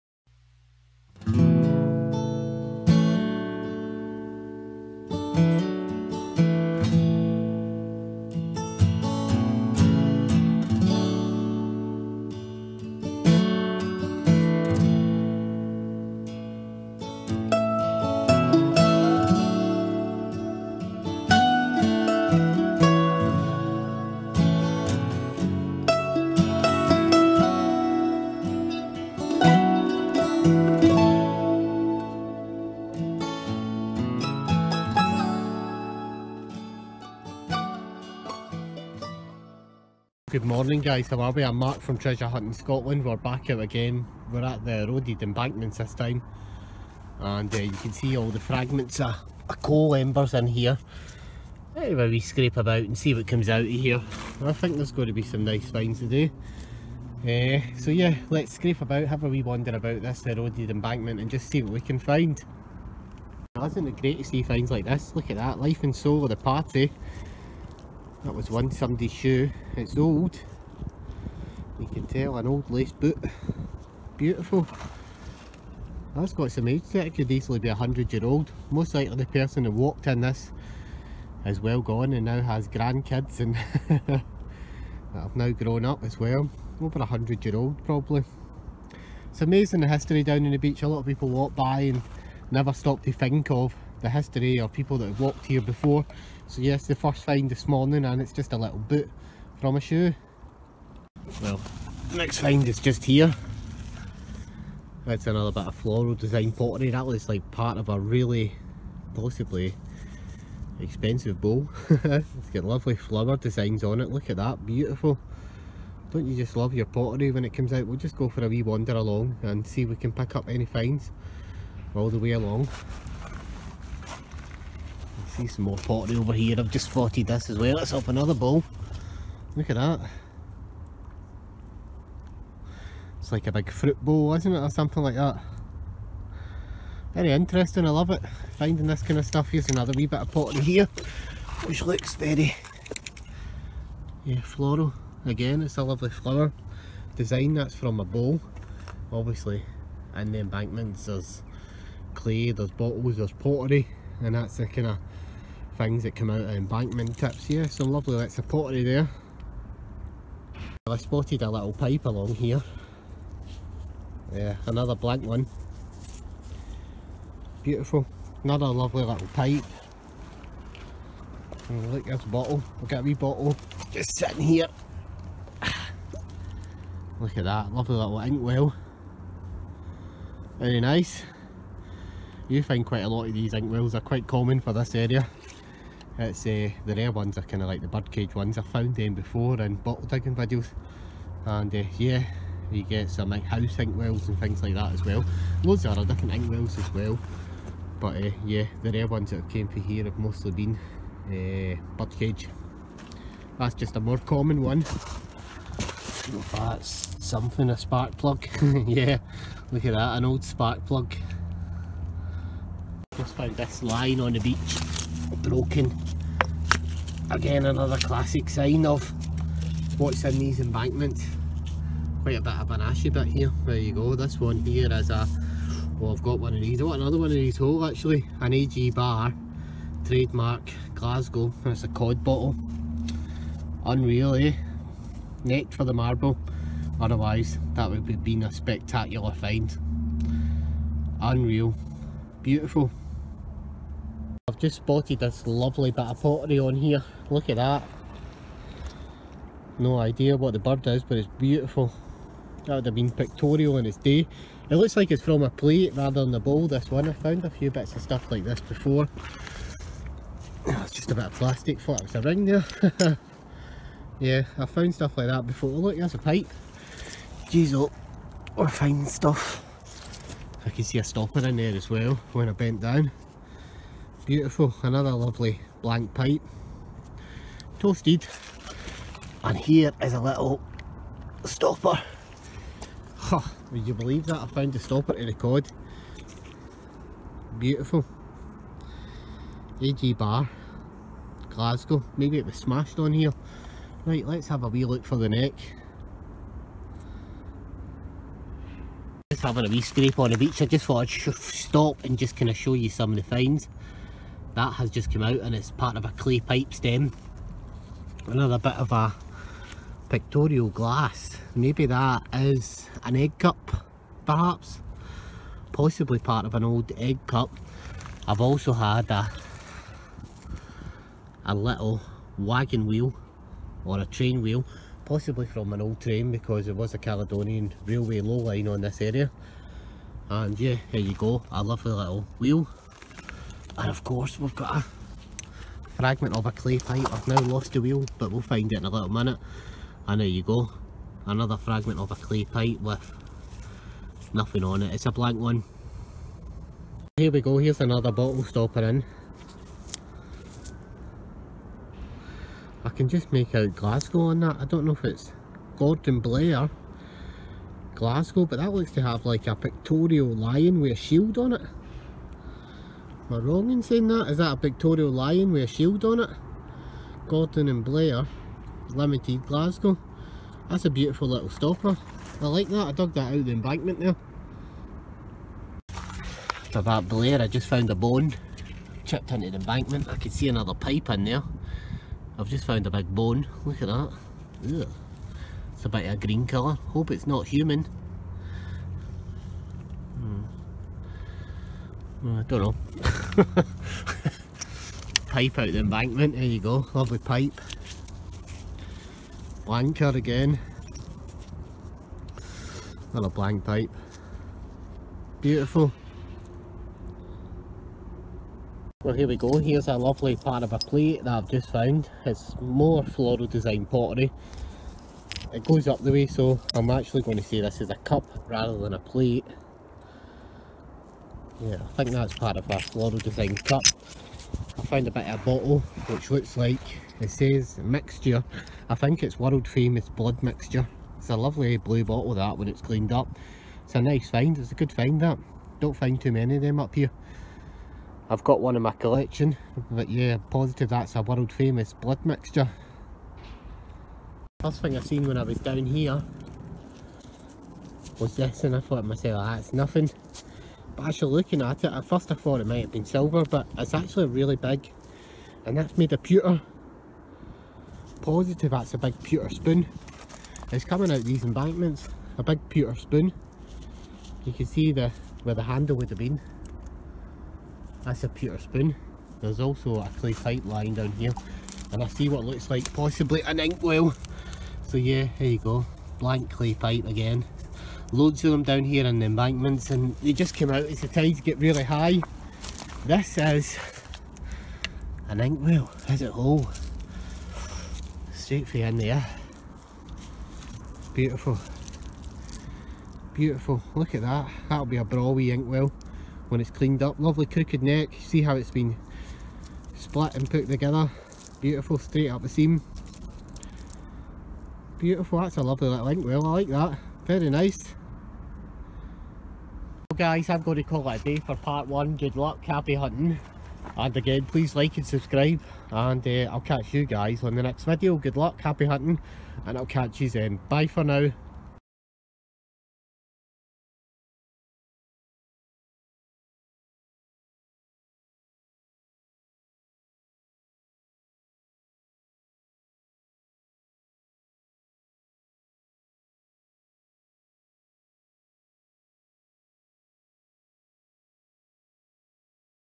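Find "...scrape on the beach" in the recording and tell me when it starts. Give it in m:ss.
4:59.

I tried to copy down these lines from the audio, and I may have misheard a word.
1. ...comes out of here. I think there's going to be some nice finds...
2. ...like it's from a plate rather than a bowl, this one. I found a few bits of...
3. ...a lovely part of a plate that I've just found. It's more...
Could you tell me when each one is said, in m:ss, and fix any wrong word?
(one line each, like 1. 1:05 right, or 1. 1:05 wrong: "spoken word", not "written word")
1. 0:53 right
2. 4:14 right
3. 6:49 right.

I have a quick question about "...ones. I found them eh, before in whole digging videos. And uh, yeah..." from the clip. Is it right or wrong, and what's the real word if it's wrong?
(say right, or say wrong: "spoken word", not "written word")
wrong: "bottle", not "whole".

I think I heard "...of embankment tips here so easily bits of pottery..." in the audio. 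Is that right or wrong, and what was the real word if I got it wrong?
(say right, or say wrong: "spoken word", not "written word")
wrong: "lovely", not "easily".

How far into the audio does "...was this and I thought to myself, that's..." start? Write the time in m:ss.
7:28.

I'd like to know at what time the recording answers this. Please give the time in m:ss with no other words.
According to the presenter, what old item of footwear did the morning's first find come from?
1:12.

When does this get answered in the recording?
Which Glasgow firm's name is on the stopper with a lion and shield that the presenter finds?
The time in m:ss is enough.
6:07.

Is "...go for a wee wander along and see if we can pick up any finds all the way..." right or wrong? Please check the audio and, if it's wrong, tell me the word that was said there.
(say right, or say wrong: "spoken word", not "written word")
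right.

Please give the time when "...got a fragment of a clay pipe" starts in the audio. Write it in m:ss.
5:34.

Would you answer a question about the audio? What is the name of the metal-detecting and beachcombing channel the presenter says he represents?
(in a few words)
Treasure Hunting Scotland.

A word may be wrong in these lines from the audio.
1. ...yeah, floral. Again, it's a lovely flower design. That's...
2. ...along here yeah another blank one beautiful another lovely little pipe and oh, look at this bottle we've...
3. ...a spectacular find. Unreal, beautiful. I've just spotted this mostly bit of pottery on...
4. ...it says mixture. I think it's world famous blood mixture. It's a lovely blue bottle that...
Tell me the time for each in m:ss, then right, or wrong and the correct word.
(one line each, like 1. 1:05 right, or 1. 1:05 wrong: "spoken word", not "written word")
1. 2:24 right
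2. 2:42 right
3. 3:58 wrong: "lovely", not "mostly"
4. 7:07 right.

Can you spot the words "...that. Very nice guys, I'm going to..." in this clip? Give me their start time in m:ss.
8:26.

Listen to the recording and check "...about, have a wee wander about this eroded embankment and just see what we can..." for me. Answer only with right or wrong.
right.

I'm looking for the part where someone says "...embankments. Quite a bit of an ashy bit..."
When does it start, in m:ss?
3:40.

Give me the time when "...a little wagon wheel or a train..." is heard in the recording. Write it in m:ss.
5:21.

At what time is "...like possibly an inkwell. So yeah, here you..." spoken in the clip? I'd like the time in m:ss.
7:52.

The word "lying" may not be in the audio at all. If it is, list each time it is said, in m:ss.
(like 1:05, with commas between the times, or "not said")
3:33, 7:50.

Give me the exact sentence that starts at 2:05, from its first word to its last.
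See some more pottery over here.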